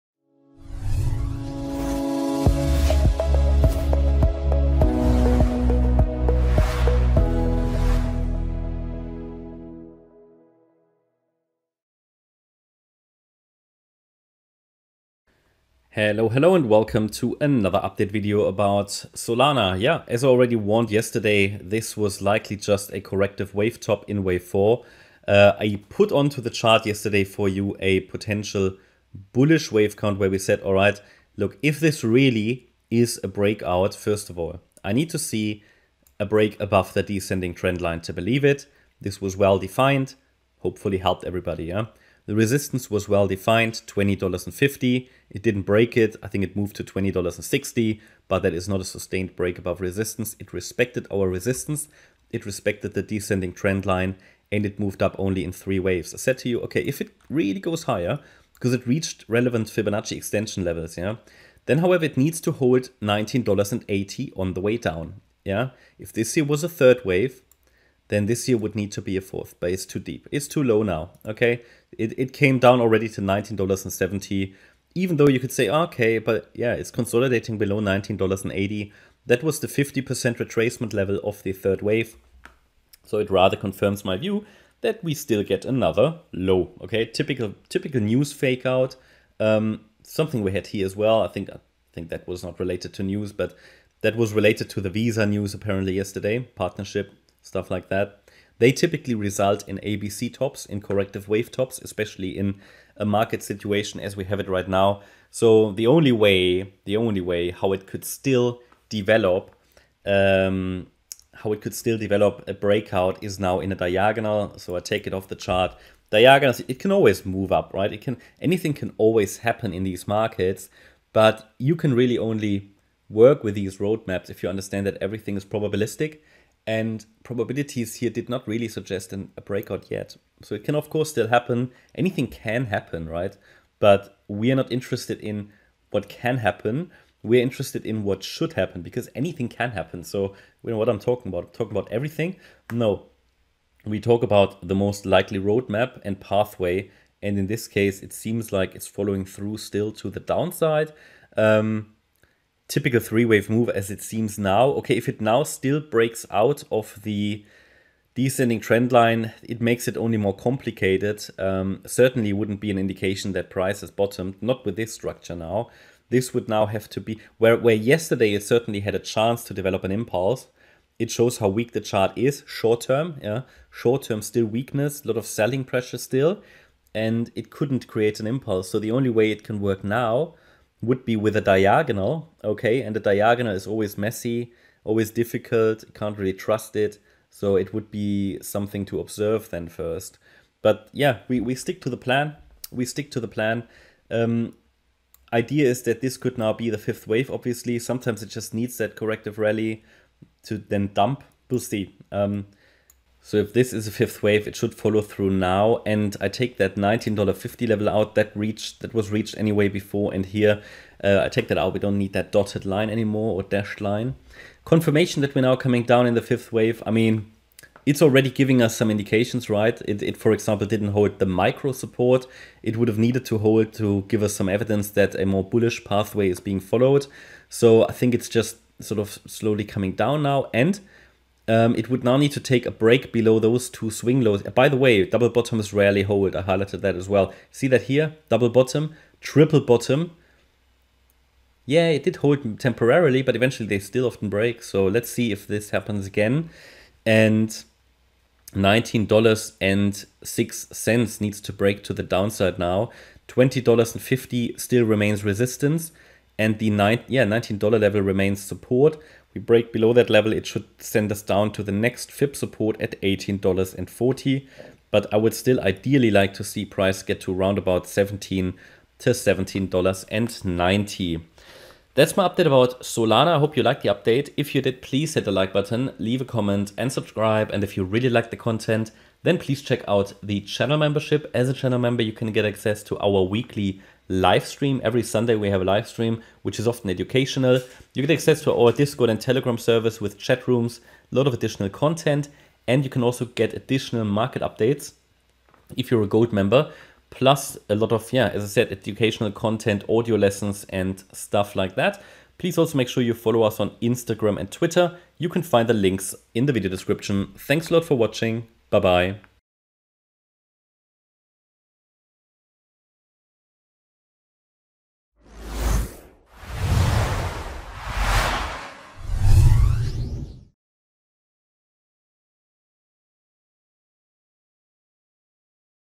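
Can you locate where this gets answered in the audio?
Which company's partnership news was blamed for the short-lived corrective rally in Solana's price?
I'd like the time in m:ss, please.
1:34.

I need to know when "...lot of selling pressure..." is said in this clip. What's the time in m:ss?
2:55.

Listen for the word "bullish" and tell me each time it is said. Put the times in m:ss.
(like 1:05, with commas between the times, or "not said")
0:29, 3:45.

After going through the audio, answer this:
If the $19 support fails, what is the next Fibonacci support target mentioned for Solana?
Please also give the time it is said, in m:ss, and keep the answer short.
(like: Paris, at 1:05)
$18.40, at 4:23.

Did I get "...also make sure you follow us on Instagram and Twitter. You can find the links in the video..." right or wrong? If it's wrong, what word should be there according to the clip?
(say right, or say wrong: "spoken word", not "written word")
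right.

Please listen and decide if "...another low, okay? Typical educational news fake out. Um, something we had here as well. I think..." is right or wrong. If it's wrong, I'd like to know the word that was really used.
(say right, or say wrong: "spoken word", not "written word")
wrong: "typical", not "educational".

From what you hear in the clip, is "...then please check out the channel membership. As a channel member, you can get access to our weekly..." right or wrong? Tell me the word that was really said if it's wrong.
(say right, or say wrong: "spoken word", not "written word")
right.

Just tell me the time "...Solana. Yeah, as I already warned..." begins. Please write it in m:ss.
0:19.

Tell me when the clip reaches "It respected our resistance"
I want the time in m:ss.
0:50.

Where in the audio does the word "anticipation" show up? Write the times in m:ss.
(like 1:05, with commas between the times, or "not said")
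not said.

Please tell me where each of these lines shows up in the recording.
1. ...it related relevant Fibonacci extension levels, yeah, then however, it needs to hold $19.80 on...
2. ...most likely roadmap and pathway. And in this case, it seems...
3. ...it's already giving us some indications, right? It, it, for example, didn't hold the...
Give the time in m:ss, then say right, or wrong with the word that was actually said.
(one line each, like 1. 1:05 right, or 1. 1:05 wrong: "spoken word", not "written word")
1. 0:58 wrong: "reached", not "related"
2. 2:24 right
3. 3:37 right.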